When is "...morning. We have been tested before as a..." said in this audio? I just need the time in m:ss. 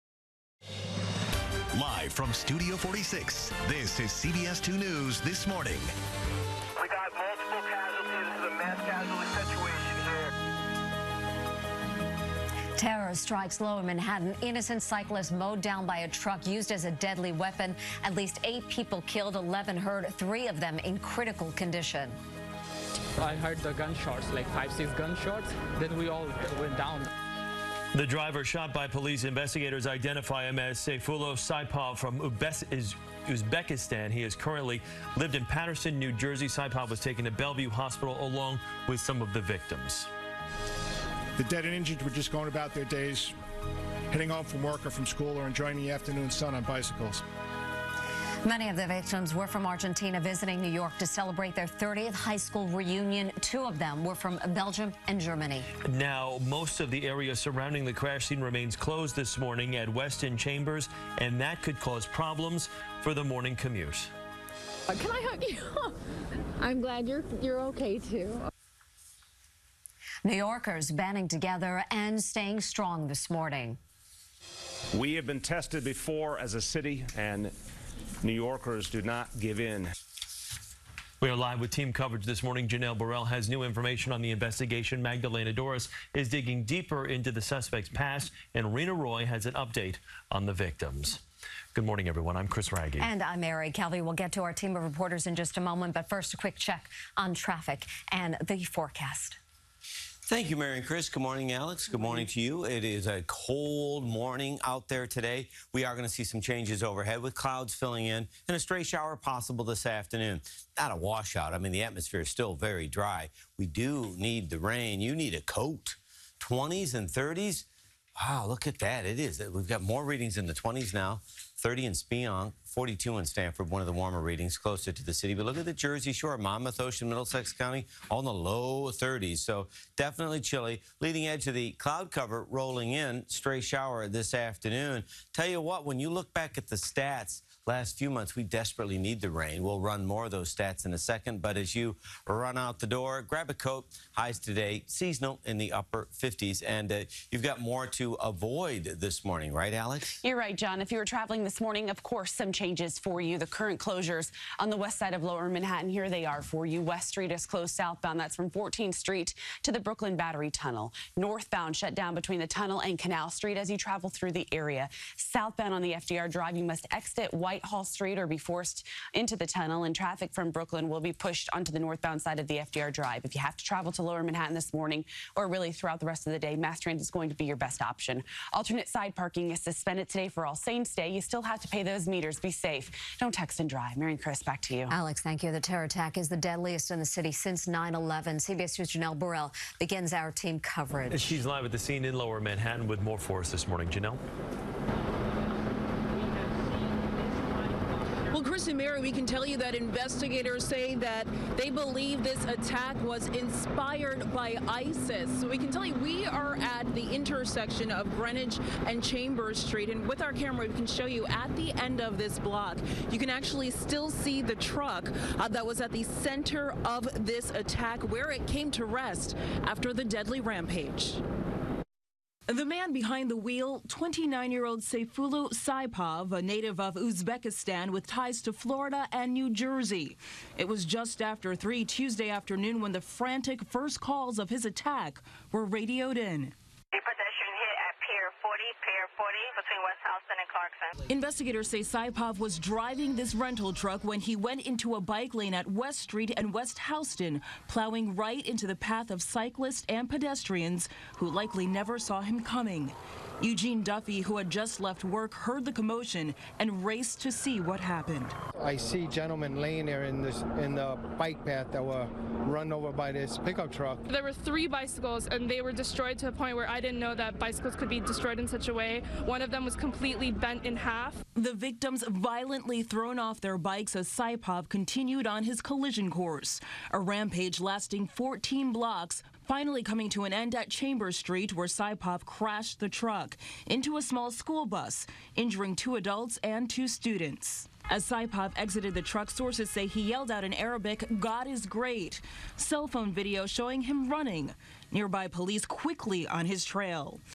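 1:13.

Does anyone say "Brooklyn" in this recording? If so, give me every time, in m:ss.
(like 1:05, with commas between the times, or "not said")
2:39, 2:50.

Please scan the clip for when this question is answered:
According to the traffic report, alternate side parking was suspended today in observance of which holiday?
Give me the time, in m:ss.
3:00.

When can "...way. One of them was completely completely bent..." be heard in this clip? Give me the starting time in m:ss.
4:28.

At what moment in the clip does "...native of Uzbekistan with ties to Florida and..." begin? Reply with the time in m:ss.
3:46.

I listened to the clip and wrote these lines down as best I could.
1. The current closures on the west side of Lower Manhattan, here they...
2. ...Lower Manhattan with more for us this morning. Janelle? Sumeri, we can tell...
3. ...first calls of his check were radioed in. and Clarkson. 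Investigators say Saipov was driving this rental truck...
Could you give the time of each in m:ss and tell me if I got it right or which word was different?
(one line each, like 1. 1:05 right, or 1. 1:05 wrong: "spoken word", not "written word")
1. 2:33 right
2. 3:12 right
3. 3:53 wrong: "attack", not "check".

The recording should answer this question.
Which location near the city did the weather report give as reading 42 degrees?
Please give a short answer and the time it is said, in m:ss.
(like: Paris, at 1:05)
Stamford, at 2:03.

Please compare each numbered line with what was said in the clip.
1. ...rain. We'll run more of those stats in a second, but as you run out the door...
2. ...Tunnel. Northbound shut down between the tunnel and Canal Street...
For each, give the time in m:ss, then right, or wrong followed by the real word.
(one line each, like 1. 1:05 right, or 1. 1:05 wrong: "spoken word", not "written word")
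1. 2:19 right
2. 2:40 right.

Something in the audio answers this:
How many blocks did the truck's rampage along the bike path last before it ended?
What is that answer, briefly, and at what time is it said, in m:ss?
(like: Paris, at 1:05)
14, at 4:38.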